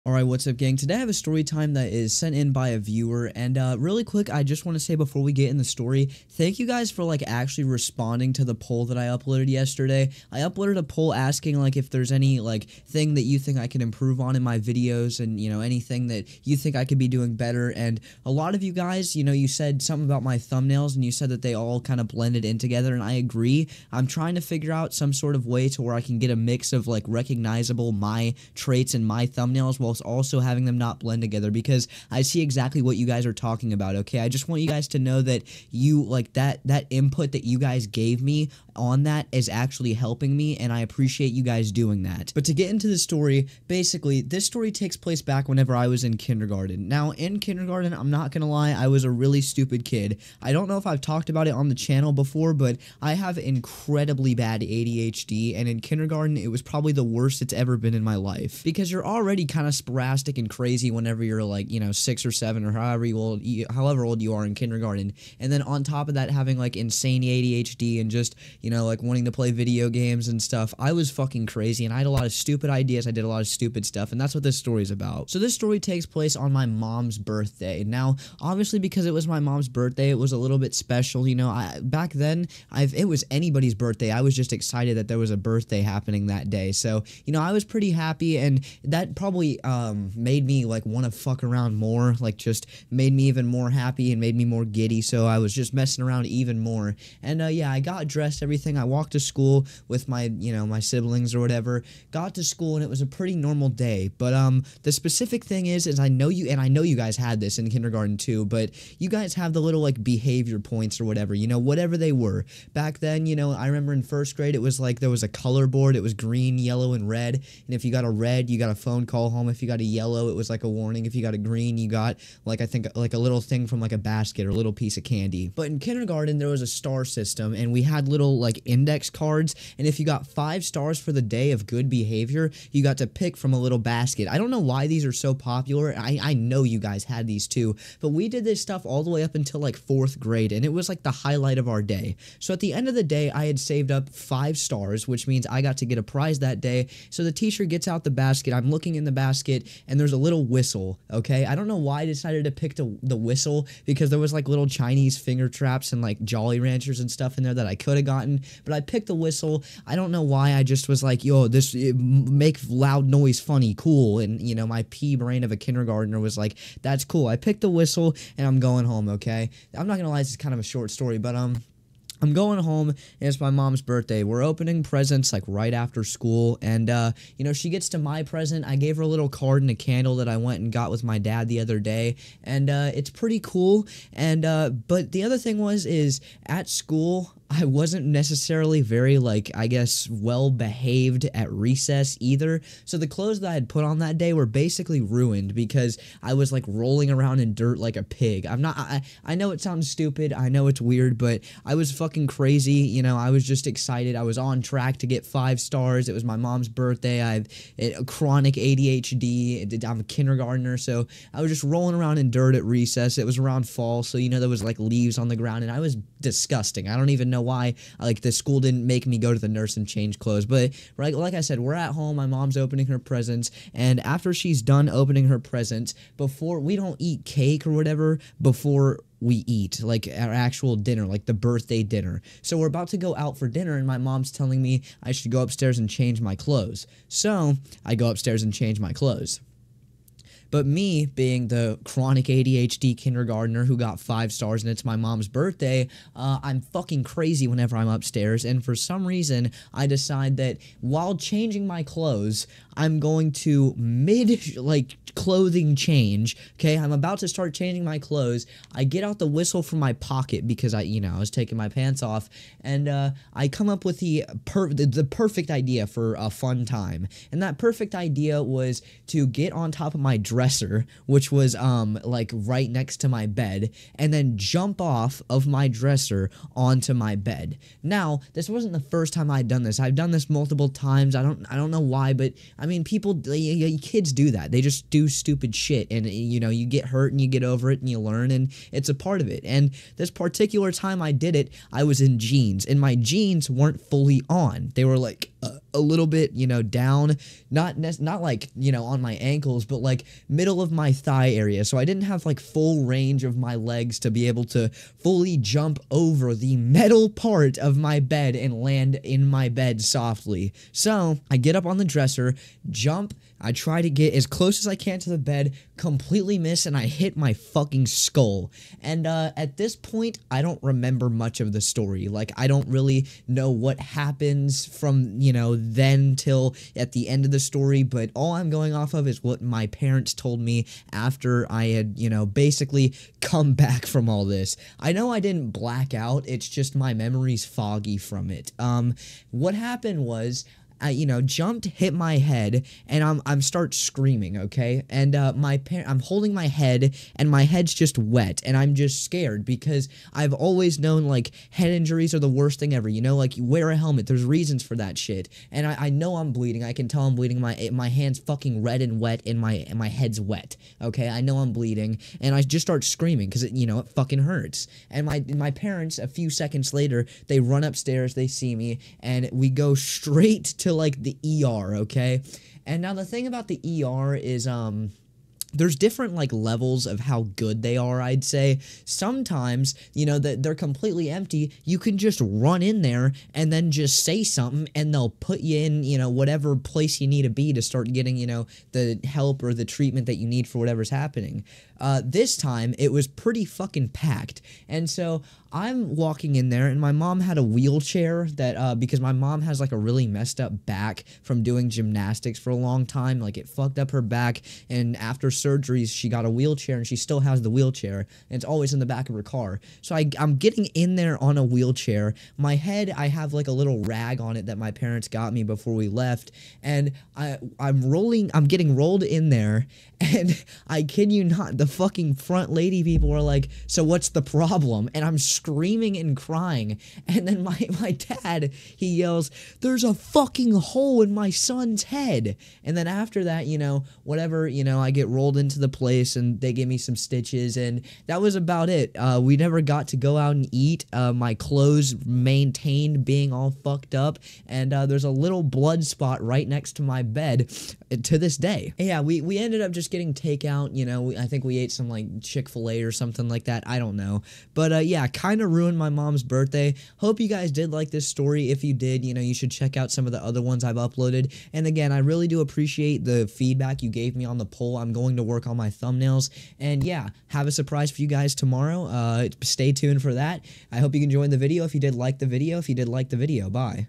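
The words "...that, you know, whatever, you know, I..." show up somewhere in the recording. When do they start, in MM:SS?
07:13.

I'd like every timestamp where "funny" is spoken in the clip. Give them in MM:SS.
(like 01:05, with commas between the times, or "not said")
02:43.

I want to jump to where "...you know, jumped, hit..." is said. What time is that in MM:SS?
05:40.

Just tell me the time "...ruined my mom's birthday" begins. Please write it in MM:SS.
07:35.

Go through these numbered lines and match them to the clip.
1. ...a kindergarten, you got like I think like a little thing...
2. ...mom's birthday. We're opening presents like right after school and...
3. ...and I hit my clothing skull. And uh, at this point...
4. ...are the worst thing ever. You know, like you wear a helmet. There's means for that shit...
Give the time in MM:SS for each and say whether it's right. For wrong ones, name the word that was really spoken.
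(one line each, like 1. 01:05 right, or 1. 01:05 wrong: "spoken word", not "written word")
1. 02:01 wrong: "green", not "kindergarten"
2. 02:53 right
3. 05:16 wrong: "fucking", not "clothing"
4. 05:52 wrong: "reasons", not "means".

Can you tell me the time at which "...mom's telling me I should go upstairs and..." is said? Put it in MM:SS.
03:53.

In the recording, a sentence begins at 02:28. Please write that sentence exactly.
I'm looking in the basket and there's a little whistle, okay?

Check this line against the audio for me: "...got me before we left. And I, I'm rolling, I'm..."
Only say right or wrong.
right.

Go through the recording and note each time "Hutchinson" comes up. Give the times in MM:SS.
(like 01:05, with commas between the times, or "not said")
not said.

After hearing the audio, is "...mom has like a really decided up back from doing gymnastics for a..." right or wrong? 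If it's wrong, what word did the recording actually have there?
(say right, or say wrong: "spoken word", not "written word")
wrong: "messed", not "decided".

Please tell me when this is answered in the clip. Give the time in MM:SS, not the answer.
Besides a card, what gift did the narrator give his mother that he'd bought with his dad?
02:59.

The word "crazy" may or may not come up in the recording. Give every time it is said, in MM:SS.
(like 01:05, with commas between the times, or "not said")
01:00, 01:11, 03:22, 04:07.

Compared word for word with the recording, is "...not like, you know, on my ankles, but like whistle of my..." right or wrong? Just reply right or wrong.
wrong.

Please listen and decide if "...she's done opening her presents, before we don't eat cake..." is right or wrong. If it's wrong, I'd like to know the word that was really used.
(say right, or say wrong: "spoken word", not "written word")
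right.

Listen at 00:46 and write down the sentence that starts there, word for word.
Now, in kindergarten, I'm not gonna lie, I was a really stupid kid.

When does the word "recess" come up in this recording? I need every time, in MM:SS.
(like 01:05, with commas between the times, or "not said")
03:11, 03:32.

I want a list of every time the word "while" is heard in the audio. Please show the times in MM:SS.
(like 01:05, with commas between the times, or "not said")
00:29, 04:10.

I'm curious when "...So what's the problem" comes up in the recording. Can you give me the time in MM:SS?
07:03.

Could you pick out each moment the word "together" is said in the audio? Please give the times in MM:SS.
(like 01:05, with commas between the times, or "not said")
00:22, 00:31.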